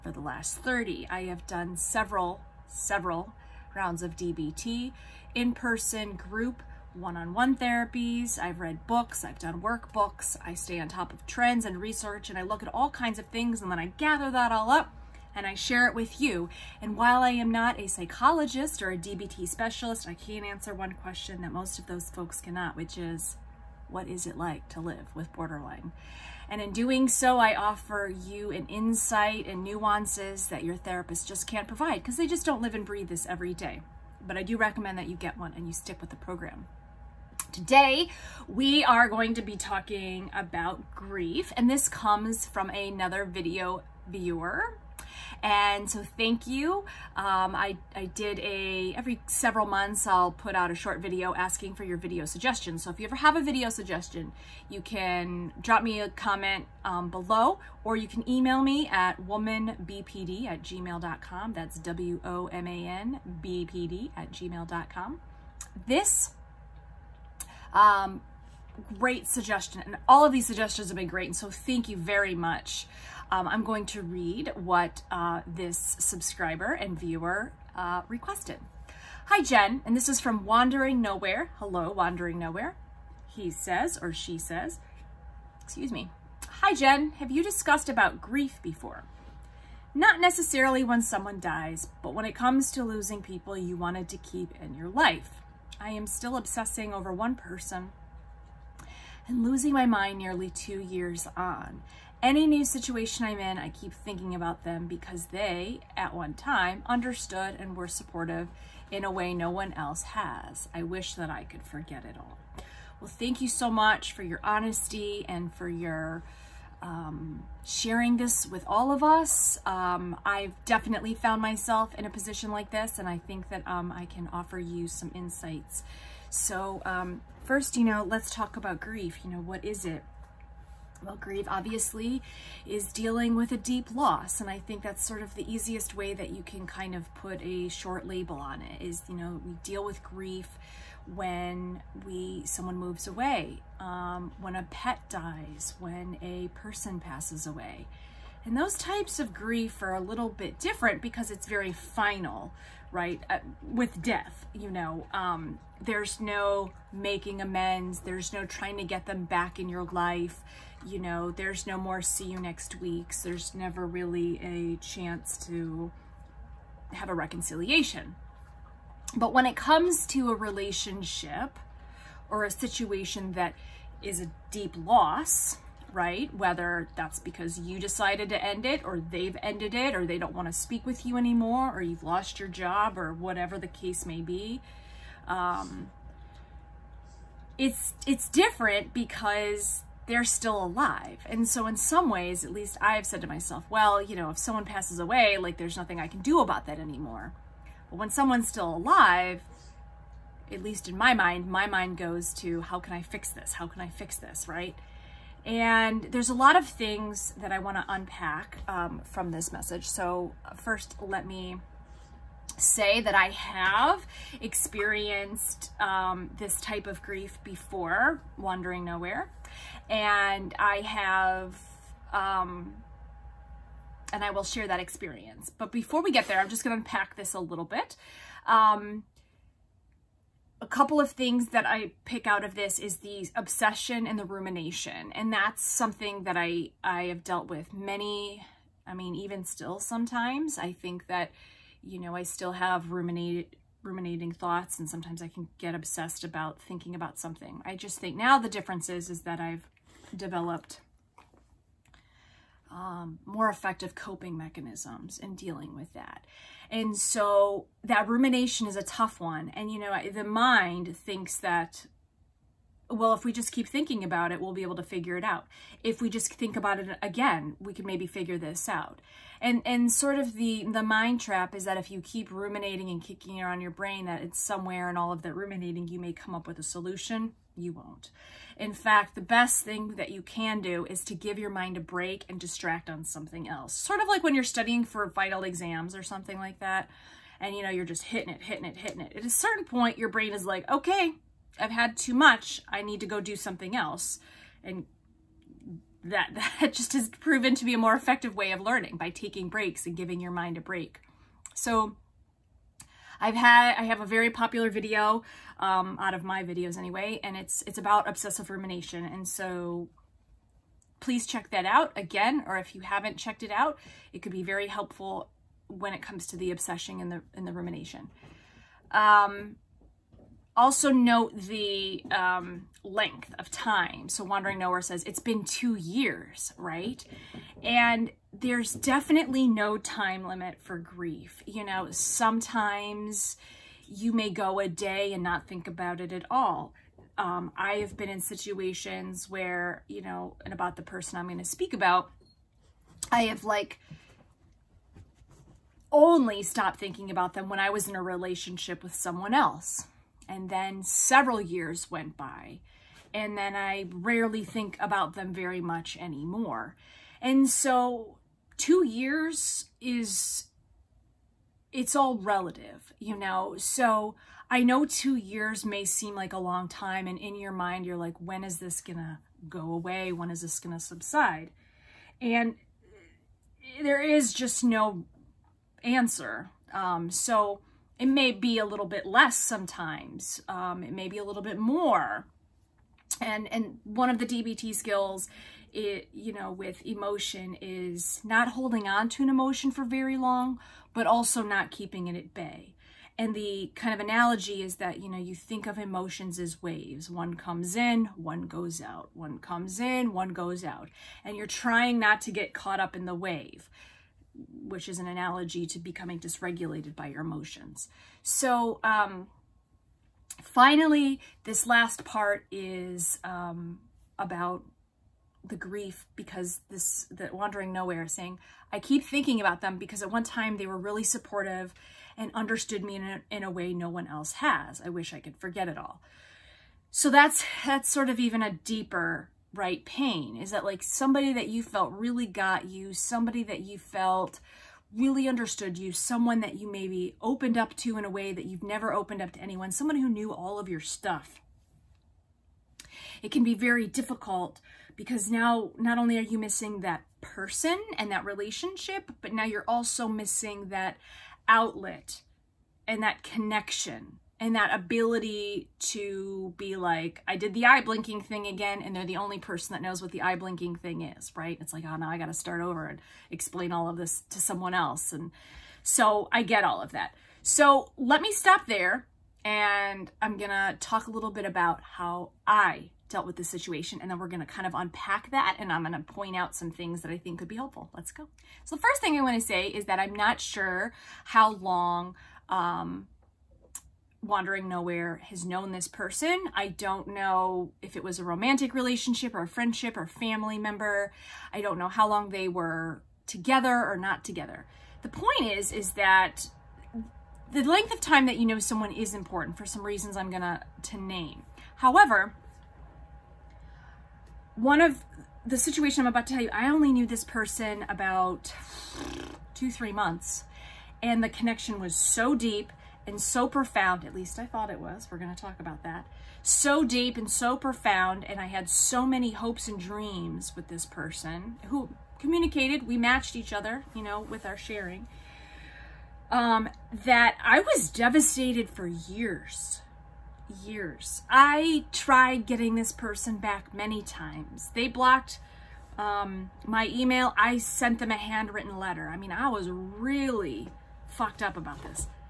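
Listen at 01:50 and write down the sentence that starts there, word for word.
I wish that I could forget it all.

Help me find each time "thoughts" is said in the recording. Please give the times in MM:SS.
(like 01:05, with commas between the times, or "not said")
04:04, 08:34.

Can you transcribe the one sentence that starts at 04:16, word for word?
And so that rumination is a tough one.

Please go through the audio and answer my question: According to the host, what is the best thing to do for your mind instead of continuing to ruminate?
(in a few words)
distract on something else.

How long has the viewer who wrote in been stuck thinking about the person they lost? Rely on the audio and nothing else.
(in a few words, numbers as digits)
nearly two years.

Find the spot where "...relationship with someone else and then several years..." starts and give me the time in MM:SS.
05:48.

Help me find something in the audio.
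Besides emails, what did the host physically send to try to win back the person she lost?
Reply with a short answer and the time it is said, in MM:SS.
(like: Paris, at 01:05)
a handwritten letter, at 08:58.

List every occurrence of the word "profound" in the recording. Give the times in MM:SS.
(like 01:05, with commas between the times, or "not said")
08:33, 08:37.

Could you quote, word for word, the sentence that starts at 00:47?
Um, I, I did a, every several months I'll put out a short video asking for your video suggestions.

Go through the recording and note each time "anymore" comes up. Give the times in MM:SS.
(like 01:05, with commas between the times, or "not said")
03:01, 03:16, 05:55.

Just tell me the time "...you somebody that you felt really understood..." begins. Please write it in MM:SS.
07:12.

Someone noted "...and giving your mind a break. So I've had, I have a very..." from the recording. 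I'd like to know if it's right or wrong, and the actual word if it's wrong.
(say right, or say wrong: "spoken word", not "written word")
right.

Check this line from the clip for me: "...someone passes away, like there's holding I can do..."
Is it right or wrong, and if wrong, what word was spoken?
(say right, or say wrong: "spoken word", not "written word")
wrong: "nothing", not "holding".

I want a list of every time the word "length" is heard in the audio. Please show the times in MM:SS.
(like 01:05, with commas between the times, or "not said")
05:22, 08:17.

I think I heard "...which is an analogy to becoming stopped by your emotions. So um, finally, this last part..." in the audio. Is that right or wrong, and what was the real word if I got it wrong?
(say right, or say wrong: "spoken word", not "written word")
wrong: "dysregulated", not "stopped".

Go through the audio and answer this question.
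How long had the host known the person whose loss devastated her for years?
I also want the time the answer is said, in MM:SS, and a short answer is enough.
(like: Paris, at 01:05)
two, three months, at 08:29.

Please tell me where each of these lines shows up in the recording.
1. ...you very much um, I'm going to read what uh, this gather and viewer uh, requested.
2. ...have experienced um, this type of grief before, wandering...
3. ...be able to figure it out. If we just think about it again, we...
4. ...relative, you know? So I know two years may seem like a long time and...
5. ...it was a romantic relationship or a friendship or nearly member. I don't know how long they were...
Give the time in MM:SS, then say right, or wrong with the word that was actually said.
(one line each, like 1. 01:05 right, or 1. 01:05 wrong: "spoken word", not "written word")
1. 01:11 wrong: "subscriber", not "gather"
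2. 03:33 right
3. 04:24 right
4. 06:02 right
5. 08:07 wrong: "family", not "nearly".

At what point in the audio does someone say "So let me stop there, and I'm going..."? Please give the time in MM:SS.
07:47.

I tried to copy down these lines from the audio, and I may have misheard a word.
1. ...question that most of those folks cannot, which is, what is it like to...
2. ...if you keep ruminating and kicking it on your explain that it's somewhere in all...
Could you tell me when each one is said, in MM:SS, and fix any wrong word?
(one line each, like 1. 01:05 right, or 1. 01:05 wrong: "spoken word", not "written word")
1. 00:21 right
2. 04:31 wrong: "brain", not "explain".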